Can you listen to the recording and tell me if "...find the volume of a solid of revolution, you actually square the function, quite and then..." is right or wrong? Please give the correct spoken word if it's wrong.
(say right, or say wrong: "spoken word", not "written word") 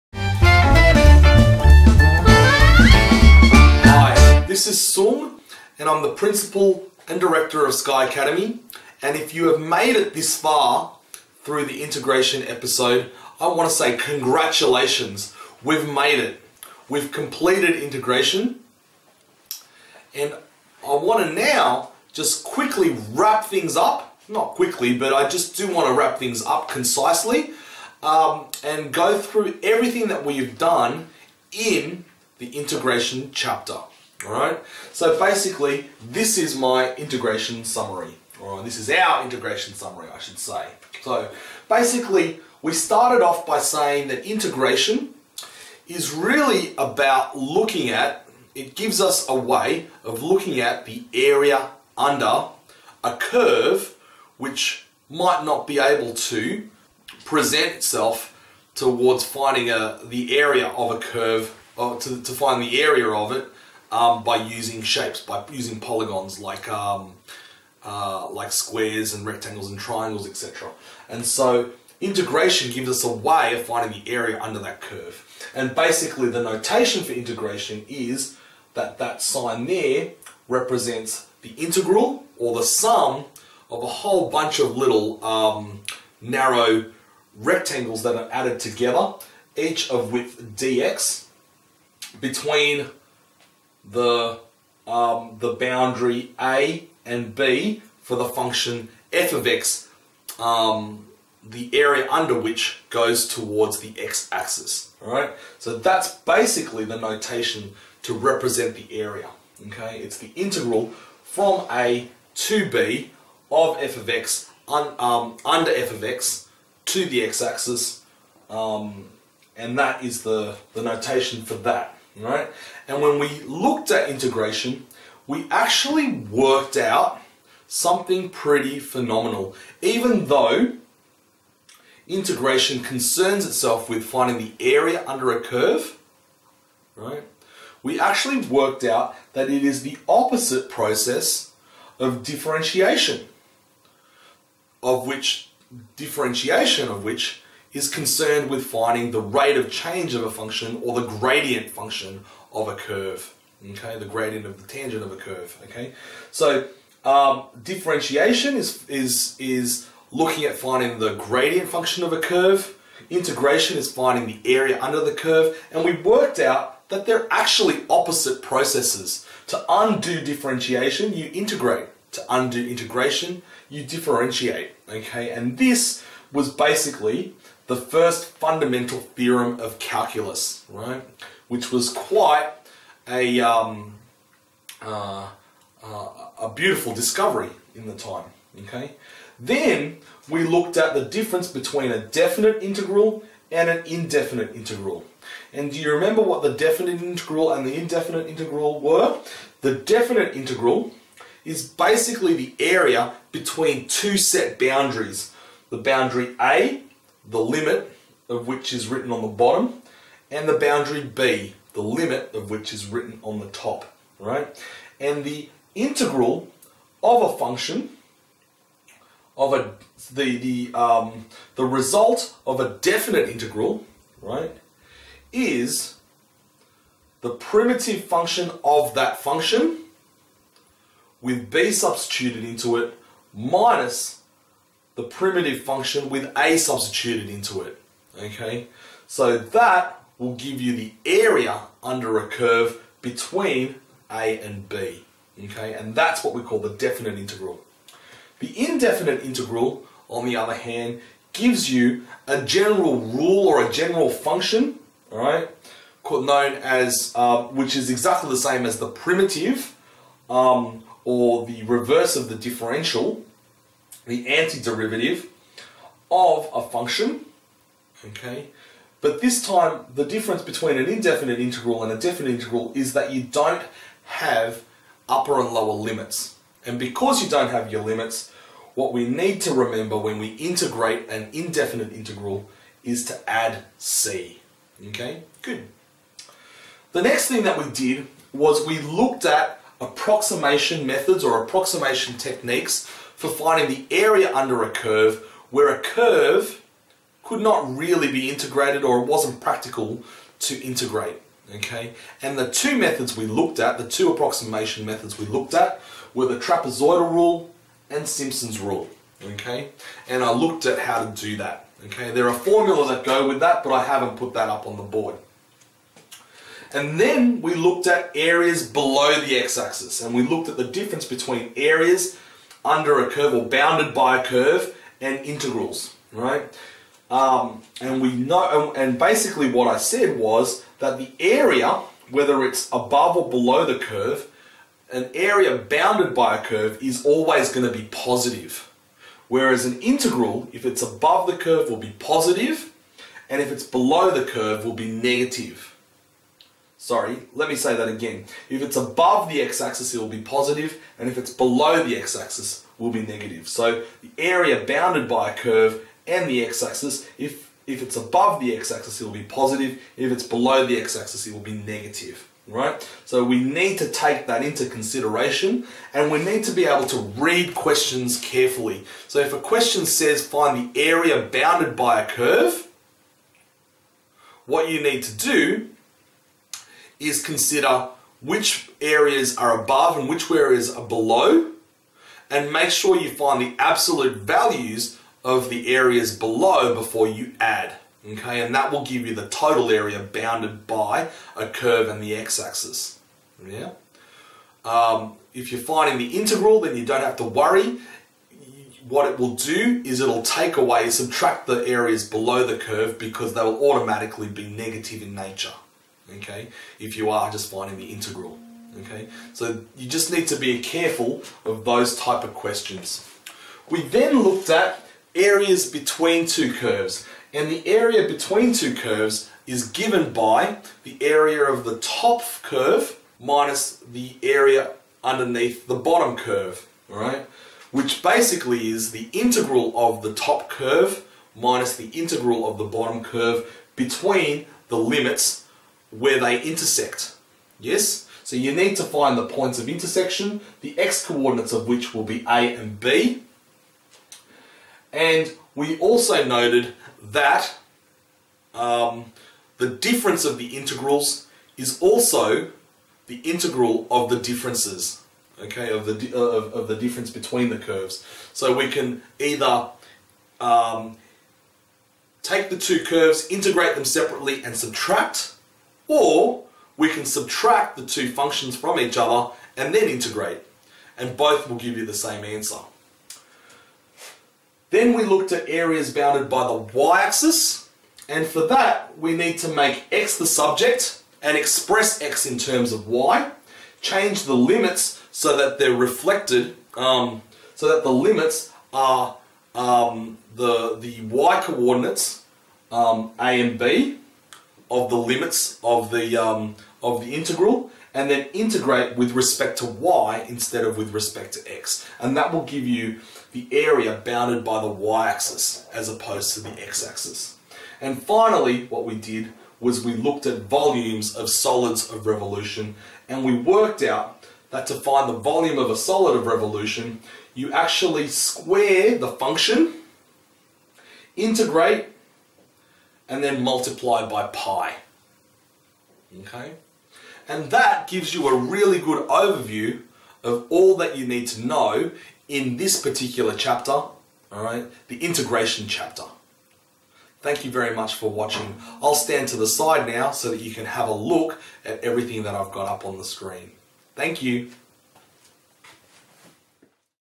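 wrong: "integrate", not "quite".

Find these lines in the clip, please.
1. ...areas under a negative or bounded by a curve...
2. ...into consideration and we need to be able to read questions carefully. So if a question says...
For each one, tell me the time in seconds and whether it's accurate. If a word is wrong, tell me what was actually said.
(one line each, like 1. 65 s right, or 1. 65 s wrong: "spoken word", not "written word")
1. 321 s wrong: "curve", not "negative"
2. 364 s right.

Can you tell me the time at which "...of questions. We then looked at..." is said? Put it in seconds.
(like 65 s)
412 s.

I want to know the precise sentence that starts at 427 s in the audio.
Which basically is the integral of the top curve minus the integral of the bottom curve between the limits where they intersect.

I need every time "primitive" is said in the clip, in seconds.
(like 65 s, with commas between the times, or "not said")
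227 s, 235 s, 258 s.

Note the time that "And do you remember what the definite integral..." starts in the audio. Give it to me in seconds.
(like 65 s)
195 s.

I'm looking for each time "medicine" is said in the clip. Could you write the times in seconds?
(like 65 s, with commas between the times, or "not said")
not said.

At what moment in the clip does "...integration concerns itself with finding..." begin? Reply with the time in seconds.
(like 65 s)
132 s.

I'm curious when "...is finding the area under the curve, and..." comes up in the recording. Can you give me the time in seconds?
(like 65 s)
163 s.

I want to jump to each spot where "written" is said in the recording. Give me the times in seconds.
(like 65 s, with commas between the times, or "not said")
208 s, 212 s.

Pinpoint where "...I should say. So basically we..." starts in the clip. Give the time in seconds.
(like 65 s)
40 s.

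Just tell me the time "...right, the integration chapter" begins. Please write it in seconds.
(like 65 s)
534 s.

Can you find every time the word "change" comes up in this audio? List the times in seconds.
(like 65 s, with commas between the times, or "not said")
149 s, 483 s.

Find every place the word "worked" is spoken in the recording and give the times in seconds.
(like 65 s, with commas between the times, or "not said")
126 s, 138 s, 166 s, 513 s.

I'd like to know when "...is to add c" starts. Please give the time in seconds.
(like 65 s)
282 s.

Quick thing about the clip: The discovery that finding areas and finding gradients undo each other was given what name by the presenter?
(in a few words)
First fundamental theorem of calculus.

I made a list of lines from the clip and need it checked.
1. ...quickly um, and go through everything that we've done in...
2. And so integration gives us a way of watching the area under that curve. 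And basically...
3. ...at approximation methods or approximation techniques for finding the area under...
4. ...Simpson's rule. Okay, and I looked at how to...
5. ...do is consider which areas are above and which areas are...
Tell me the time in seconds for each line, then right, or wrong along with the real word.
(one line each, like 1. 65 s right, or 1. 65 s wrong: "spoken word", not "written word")
1. 26 s wrong: "concisely", not "quickly"
2. 71 s wrong: "finding", not "watching"
3. 289 s right
4. 308 s right
5. 375 s right.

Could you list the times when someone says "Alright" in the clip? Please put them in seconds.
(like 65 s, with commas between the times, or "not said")
34 s, 105 s.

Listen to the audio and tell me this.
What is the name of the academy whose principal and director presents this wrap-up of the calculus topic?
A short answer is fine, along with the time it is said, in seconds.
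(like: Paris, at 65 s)
Sky Academy, at 7 s.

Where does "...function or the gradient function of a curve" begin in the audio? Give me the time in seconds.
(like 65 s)
150 s.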